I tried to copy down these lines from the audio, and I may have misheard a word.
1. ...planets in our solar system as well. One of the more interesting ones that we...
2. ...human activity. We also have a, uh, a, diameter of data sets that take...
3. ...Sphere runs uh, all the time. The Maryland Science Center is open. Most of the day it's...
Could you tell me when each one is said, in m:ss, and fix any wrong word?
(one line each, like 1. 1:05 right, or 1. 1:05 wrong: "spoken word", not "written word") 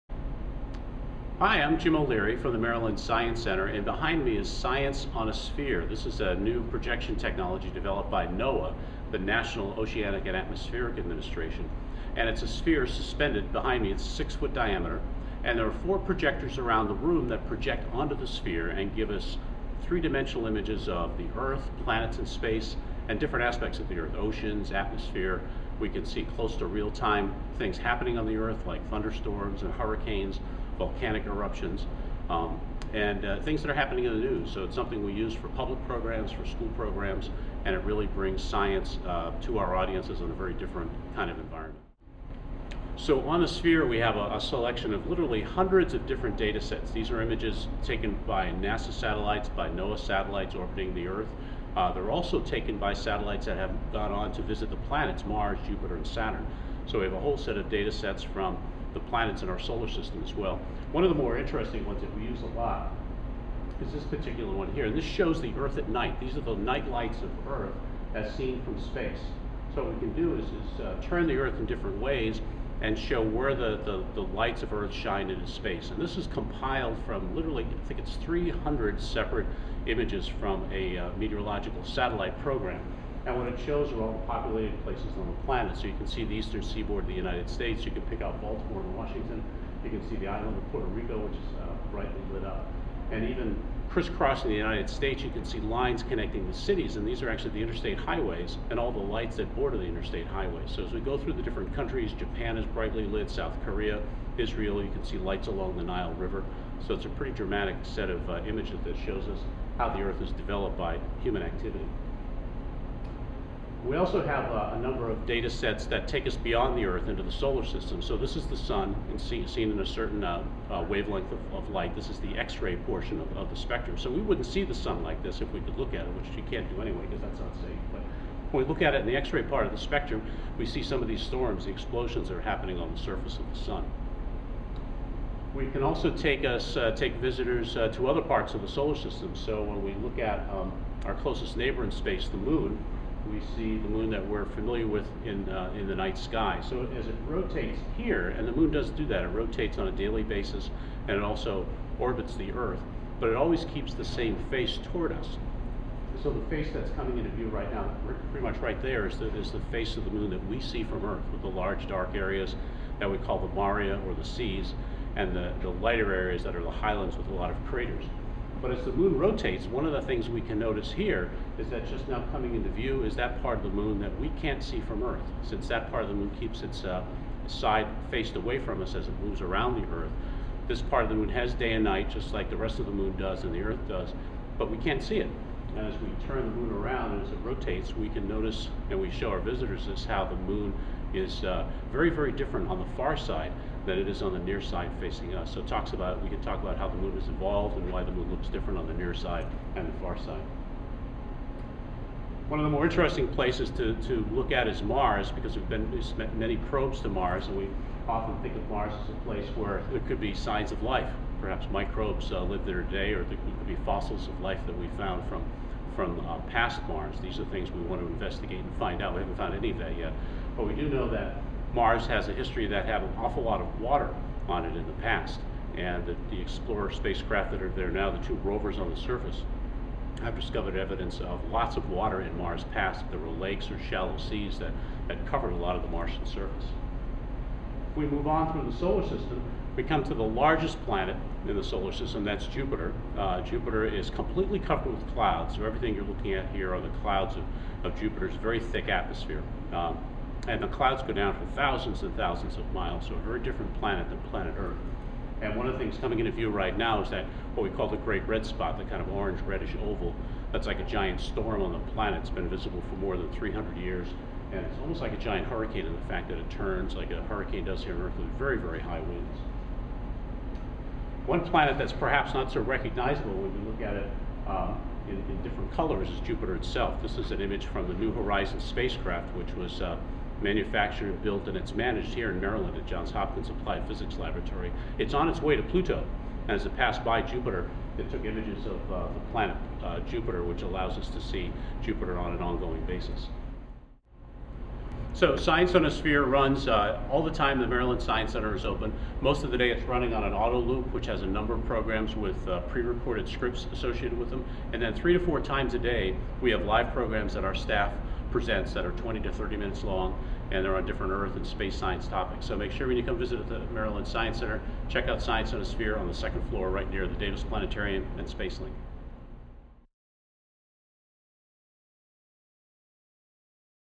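1. 0:58 right
2. 1:51 wrong: "number", not "diameter"
3. 4:55 right.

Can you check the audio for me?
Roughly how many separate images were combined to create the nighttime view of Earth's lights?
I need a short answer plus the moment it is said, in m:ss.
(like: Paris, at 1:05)
300, at 1:18.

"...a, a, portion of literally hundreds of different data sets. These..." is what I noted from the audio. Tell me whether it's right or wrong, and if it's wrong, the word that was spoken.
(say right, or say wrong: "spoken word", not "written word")
wrong: "selection", not "portion".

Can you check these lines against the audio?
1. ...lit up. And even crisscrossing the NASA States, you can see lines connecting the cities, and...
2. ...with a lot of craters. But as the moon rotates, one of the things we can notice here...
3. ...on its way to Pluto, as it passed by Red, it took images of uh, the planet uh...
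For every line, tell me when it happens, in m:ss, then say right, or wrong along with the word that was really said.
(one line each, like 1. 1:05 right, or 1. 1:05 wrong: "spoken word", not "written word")
1. 1:32 wrong: "United", not "NASA"
2. 2:47 right
3. 4:45 wrong: "Jupiter", not "Red".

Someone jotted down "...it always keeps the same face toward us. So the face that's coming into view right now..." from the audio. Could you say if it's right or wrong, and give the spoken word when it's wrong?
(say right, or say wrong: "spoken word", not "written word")
right.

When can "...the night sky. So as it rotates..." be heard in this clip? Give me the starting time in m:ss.
2:25.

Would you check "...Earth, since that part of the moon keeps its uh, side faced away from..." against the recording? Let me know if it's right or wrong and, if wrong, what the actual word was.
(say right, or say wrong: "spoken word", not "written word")
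right.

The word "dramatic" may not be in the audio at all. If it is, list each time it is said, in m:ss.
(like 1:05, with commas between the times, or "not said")
1:47.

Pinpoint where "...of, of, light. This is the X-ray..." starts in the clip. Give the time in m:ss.
2:01.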